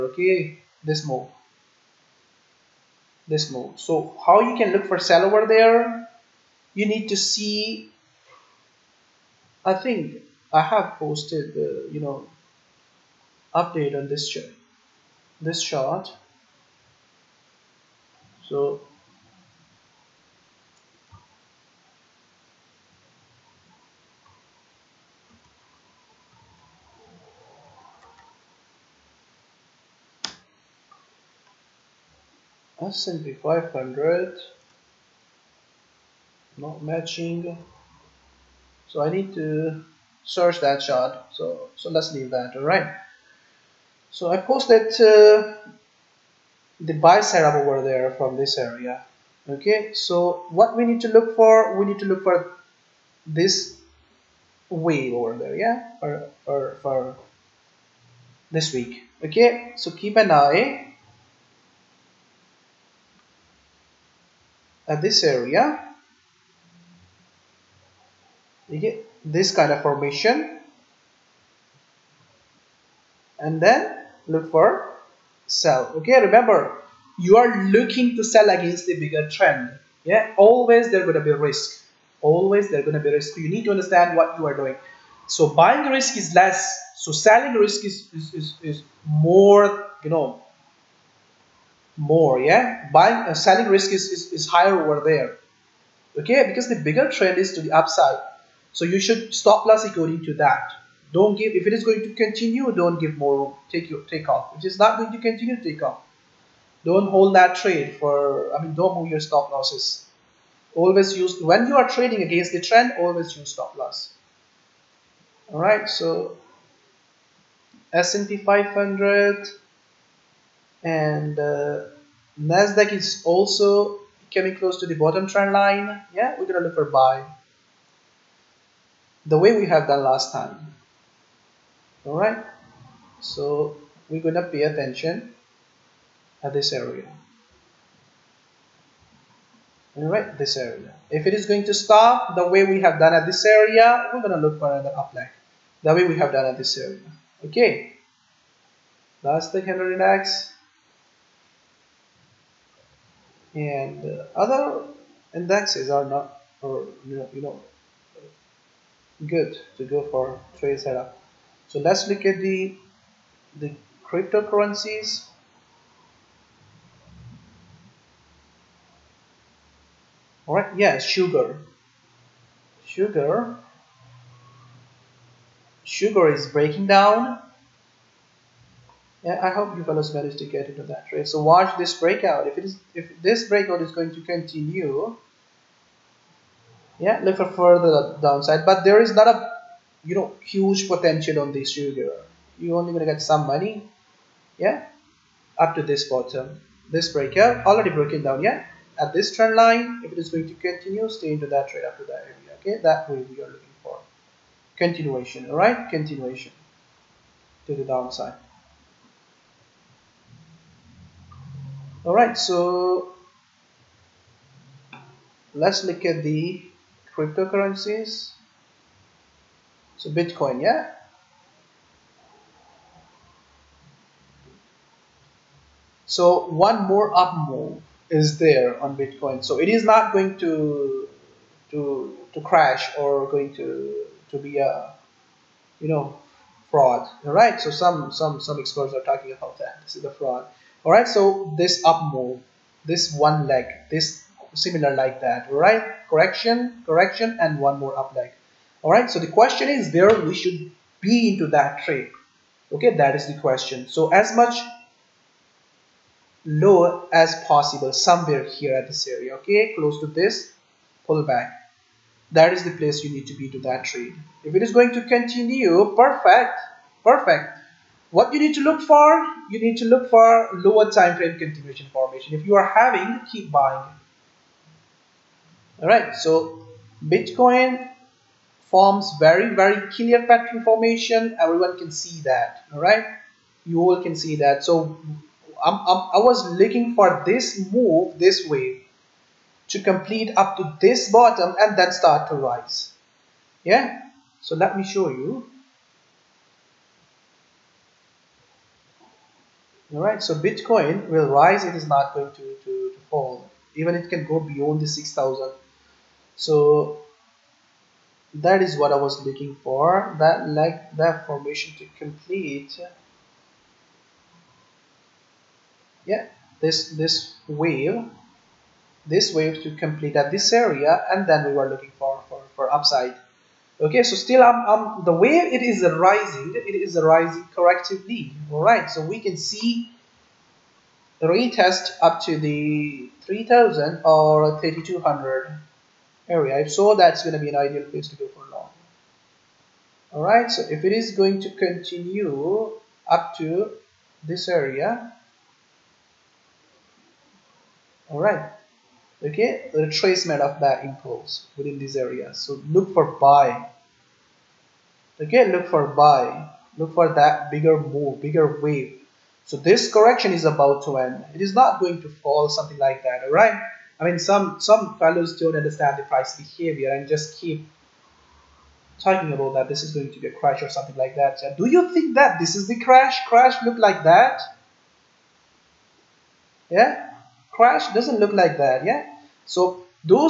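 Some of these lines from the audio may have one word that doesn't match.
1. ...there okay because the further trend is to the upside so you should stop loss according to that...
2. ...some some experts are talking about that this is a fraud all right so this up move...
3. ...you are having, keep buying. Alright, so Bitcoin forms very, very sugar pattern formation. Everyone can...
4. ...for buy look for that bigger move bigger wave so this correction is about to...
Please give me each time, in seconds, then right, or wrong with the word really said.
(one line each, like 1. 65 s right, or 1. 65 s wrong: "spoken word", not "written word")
1. 95 s wrong: "bigger", not "further"
2. 238 s right
3. 272 s wrong: "clear", not "sugar"
4. 355 s right.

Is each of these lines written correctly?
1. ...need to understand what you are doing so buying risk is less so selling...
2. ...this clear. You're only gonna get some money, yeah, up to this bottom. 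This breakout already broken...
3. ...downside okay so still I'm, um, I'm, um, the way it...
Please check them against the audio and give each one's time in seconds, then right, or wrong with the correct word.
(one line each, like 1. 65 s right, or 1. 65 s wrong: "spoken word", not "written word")
1. 83 s right
2. 191 s wrong: "sugar", not "clear"
3. 322 s wrong: "upside", not "downside".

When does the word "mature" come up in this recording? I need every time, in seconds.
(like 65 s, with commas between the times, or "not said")
not said.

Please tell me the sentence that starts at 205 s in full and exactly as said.
All right, continuation to the downside.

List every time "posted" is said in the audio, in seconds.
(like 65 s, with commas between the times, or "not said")
10 s, 44 s.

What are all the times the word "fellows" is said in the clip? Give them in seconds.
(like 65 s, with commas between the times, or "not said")
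179 s, 364 s.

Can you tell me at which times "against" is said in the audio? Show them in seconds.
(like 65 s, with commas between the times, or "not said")
78 s, 112 s.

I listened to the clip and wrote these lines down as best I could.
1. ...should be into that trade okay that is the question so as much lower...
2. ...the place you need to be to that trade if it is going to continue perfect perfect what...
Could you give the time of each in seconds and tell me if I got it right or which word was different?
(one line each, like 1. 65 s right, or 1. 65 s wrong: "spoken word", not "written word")
1. 250 s right
2. 262 s right.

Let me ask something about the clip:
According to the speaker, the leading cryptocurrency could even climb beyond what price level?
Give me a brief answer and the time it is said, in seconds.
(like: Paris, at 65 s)
6,000, at 304 s.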